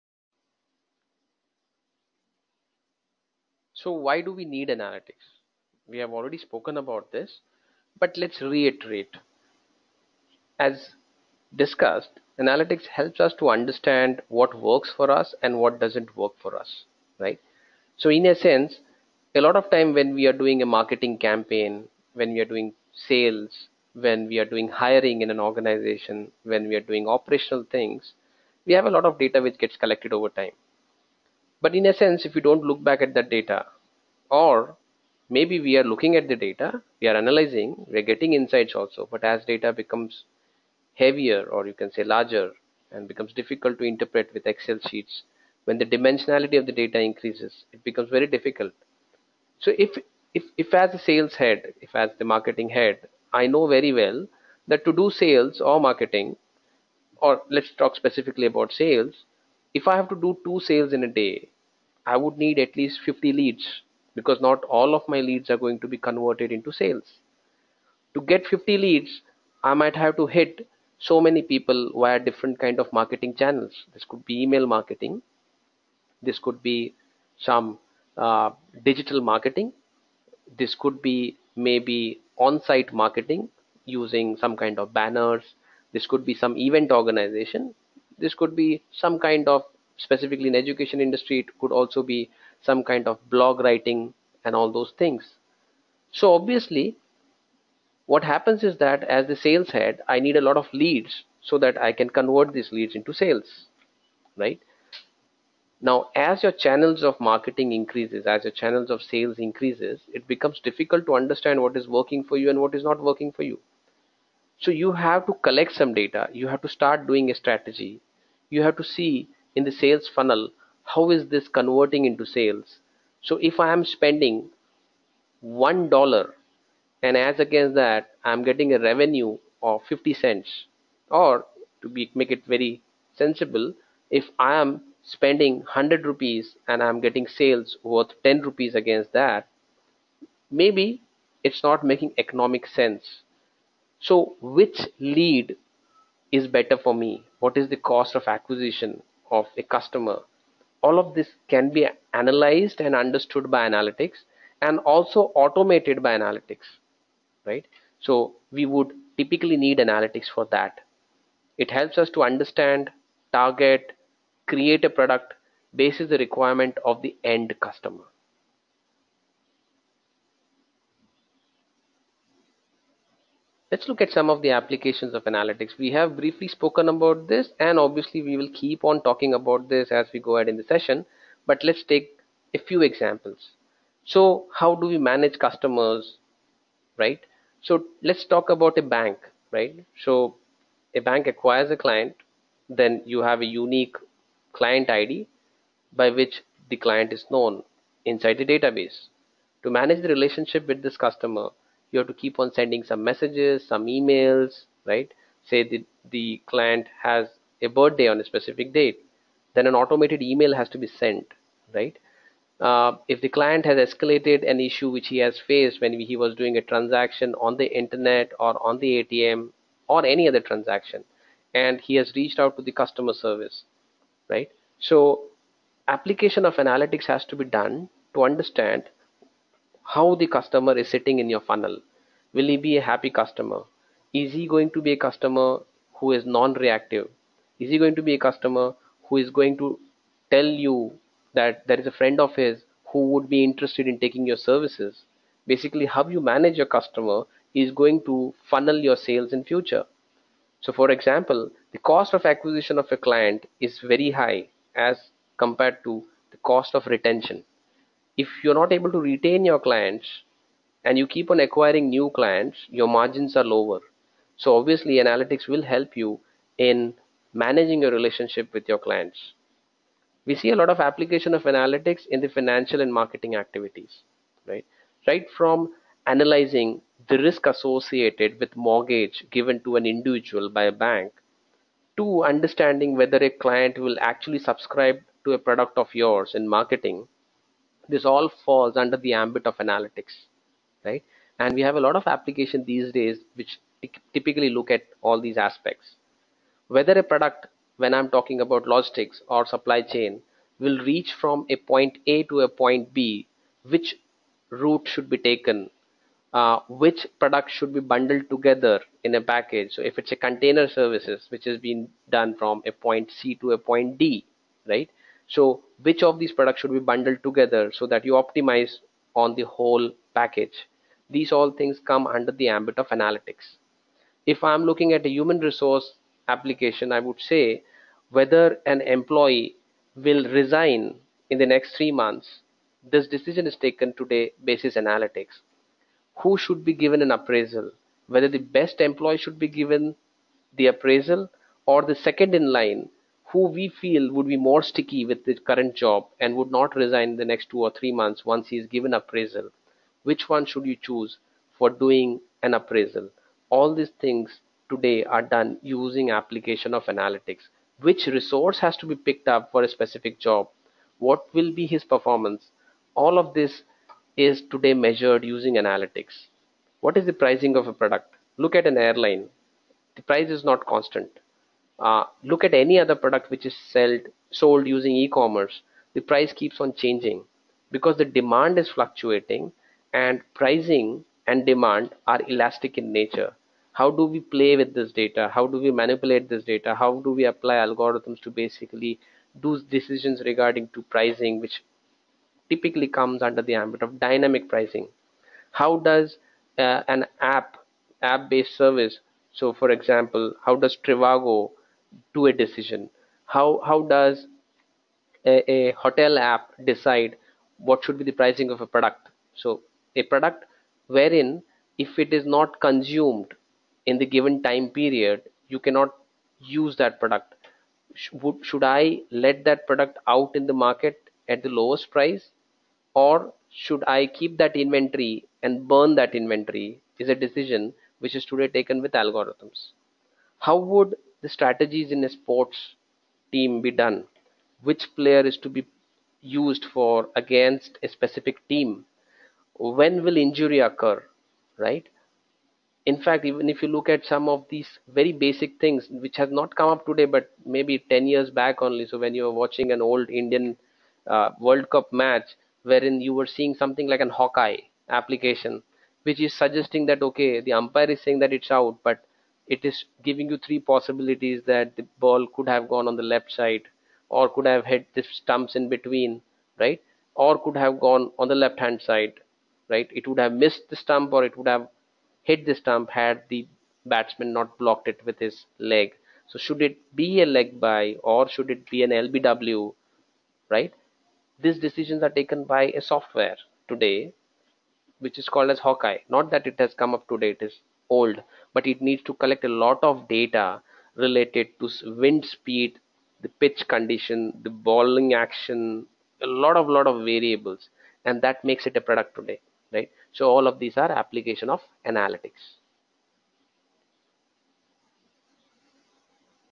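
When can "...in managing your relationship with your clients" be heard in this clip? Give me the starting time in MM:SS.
04:26.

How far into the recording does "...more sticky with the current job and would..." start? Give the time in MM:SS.
05:44.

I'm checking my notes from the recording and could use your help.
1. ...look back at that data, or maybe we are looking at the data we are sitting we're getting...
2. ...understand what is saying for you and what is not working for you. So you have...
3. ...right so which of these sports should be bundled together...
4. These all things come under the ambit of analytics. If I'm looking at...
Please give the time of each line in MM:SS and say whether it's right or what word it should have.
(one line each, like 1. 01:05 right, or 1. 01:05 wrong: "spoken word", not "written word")
1. 00:32 wrong: "analyzing", not "sitting"
2. 01:51 wrong: "working", not "saying"
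3. 05:14 wrong: "products", not "sports"
4. 05:21 right.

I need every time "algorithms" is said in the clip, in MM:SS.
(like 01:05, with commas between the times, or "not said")
06:27, 07:09.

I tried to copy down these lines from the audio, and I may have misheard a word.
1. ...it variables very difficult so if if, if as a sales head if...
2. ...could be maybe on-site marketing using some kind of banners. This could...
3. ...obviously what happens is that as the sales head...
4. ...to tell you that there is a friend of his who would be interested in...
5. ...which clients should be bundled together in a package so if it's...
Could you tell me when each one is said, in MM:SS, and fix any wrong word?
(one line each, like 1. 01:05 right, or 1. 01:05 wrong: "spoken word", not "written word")
1. 00:47 wrong: "becomes", not "variables"
2. 01:20 right
3. 01:36 right
4. 03:59 right
5. 05:06 wrong: "products", not "clients".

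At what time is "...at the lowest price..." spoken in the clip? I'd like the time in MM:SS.
07:01.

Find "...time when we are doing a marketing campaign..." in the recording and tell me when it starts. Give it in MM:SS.
00:19.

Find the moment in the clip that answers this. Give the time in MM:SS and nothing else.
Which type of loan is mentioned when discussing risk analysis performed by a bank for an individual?
04:38.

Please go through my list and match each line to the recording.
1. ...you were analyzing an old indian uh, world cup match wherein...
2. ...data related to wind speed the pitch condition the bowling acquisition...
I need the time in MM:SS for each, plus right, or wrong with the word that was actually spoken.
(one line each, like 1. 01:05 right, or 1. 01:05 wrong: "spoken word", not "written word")
1. 07:29 wrong: "watching", not "analyzing"
2. 08:10 wrong: "action", not "acquisition".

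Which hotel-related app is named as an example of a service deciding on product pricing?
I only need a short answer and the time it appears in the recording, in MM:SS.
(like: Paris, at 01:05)
Trivago, at 06:40.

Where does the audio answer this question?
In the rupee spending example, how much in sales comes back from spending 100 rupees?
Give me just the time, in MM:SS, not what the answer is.
02:18.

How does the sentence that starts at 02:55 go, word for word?
We have briefly spoken about this and obviously we will keep on talking about this as we go ahead in the session.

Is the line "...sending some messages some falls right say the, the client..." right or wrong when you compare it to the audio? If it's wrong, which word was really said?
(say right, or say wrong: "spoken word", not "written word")
wrong: "emails", not "falls".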